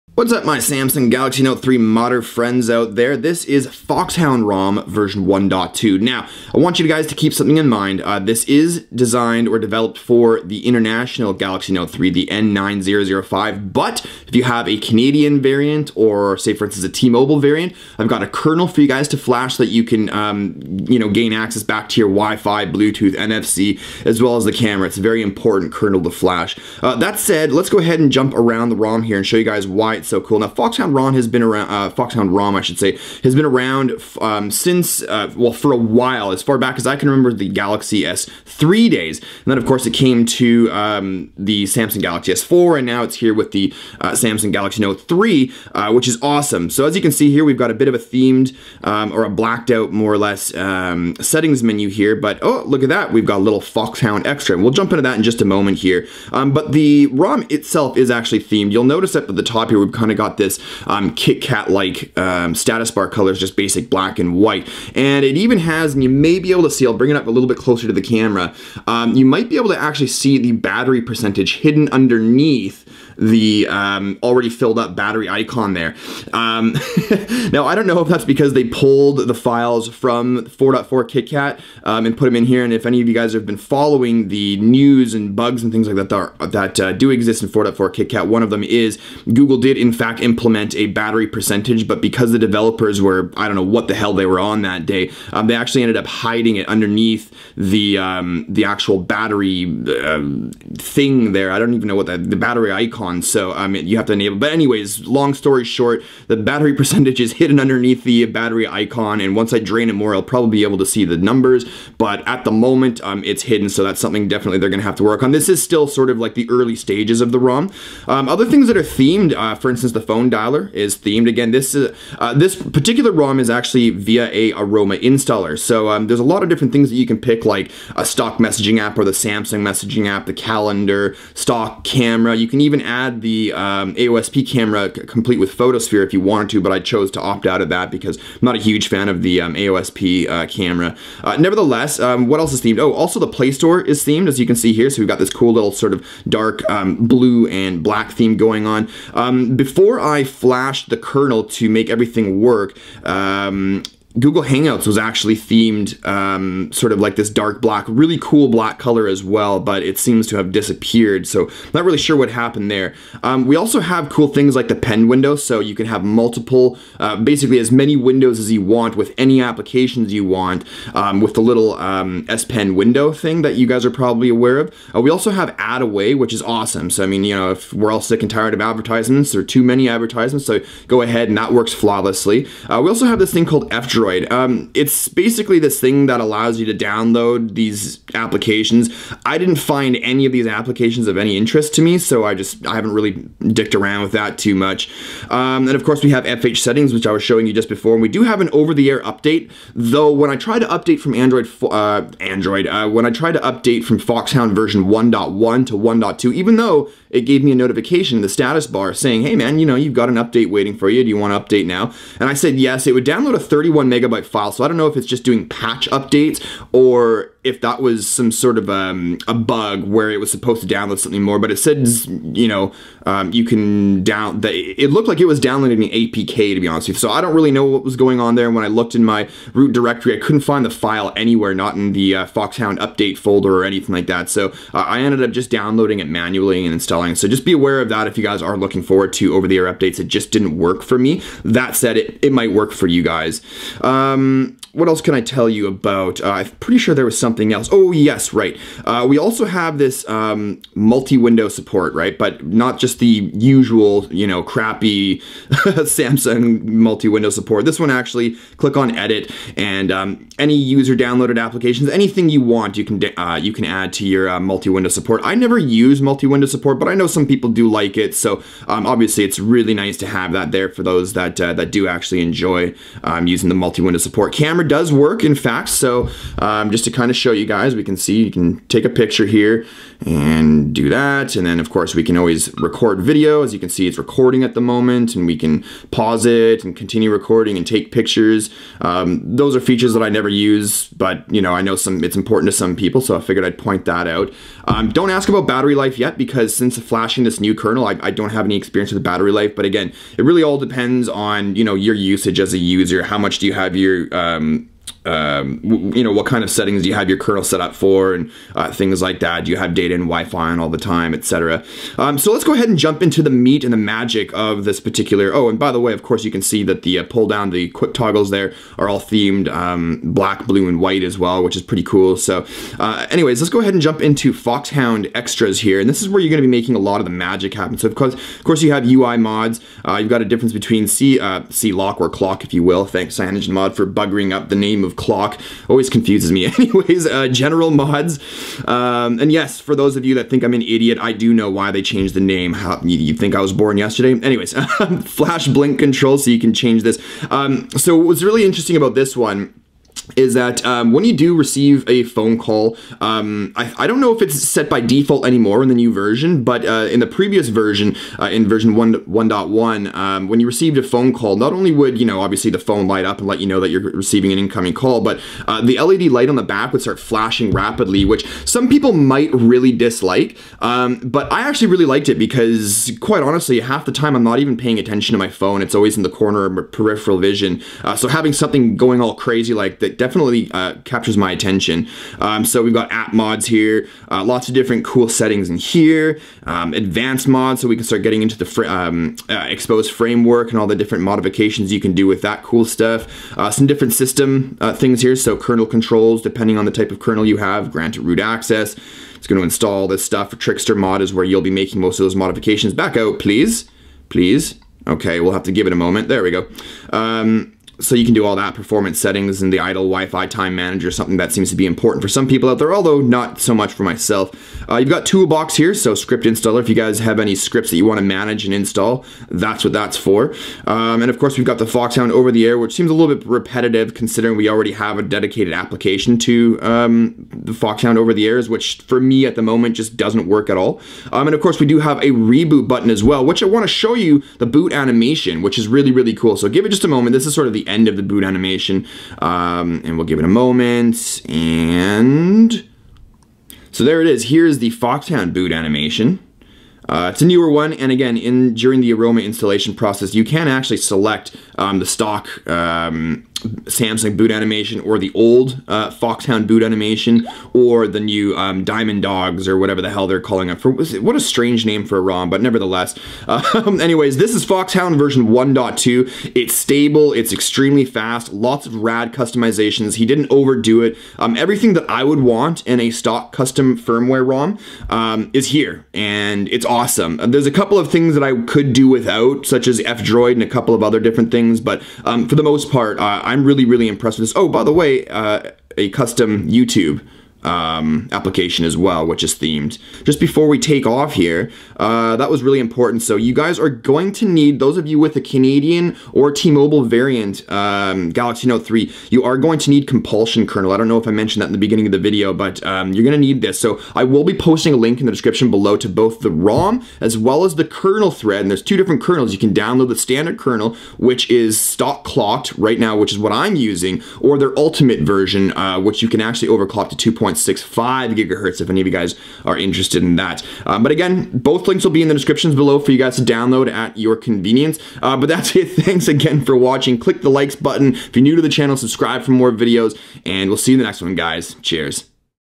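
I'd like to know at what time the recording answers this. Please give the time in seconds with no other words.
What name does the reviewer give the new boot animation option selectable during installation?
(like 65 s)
458 s.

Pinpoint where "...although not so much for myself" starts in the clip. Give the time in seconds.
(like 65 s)
412 s.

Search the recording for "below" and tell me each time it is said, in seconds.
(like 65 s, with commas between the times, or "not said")
505 s, 522 s.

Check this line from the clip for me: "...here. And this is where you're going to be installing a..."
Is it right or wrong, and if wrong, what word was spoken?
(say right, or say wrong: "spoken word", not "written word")
wrong: "making", not "installing".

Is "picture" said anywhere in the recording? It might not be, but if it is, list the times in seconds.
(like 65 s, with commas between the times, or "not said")
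278 s, 287 s.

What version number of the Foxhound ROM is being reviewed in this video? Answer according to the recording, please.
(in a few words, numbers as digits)
1.2.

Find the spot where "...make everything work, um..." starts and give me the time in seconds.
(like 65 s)
151 s.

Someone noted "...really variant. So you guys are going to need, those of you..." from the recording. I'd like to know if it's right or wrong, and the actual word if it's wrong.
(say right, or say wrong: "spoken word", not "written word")
wrong: "important", not "variant".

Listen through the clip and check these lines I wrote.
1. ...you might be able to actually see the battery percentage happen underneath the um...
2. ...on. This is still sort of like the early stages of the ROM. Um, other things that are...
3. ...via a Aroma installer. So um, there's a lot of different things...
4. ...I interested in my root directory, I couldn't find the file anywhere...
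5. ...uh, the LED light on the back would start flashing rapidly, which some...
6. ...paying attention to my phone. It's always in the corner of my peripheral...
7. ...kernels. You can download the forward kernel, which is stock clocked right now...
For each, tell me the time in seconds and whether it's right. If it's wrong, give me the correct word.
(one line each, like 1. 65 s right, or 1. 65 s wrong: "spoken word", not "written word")
1. 69 s wrong: "hidden", not "happen"
2. 115 s right
3. 123 s right
4. 228 s wrong: "looked", not "interested"
5. 365 s right
6. 374 s right
7. 509 s wrong: "standard", not "forward".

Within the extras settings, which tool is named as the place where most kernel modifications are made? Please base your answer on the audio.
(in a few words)
Trickster mod.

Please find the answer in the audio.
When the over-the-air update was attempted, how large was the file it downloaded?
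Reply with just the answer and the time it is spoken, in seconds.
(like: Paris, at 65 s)
31 megabytes, at 213 s.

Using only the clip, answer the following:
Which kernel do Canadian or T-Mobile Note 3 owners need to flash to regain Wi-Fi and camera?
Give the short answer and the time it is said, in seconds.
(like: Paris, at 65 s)
Compulsion kernel, at 499 s.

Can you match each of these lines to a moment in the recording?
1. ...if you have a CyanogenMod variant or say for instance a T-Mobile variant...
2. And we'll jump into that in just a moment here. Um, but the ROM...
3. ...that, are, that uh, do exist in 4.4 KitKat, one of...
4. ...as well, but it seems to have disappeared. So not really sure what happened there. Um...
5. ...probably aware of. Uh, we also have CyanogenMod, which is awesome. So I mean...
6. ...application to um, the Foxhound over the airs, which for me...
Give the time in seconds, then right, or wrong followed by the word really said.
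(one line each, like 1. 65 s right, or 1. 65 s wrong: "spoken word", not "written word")
1. 14 s wrong: "Canadian", not "CyanogenMod"
2. 54 s right
3. 86 s right
4. 159 s right
5. 173 s wrong: "AdAway", not "CyanogenMod"
6. 425 s right.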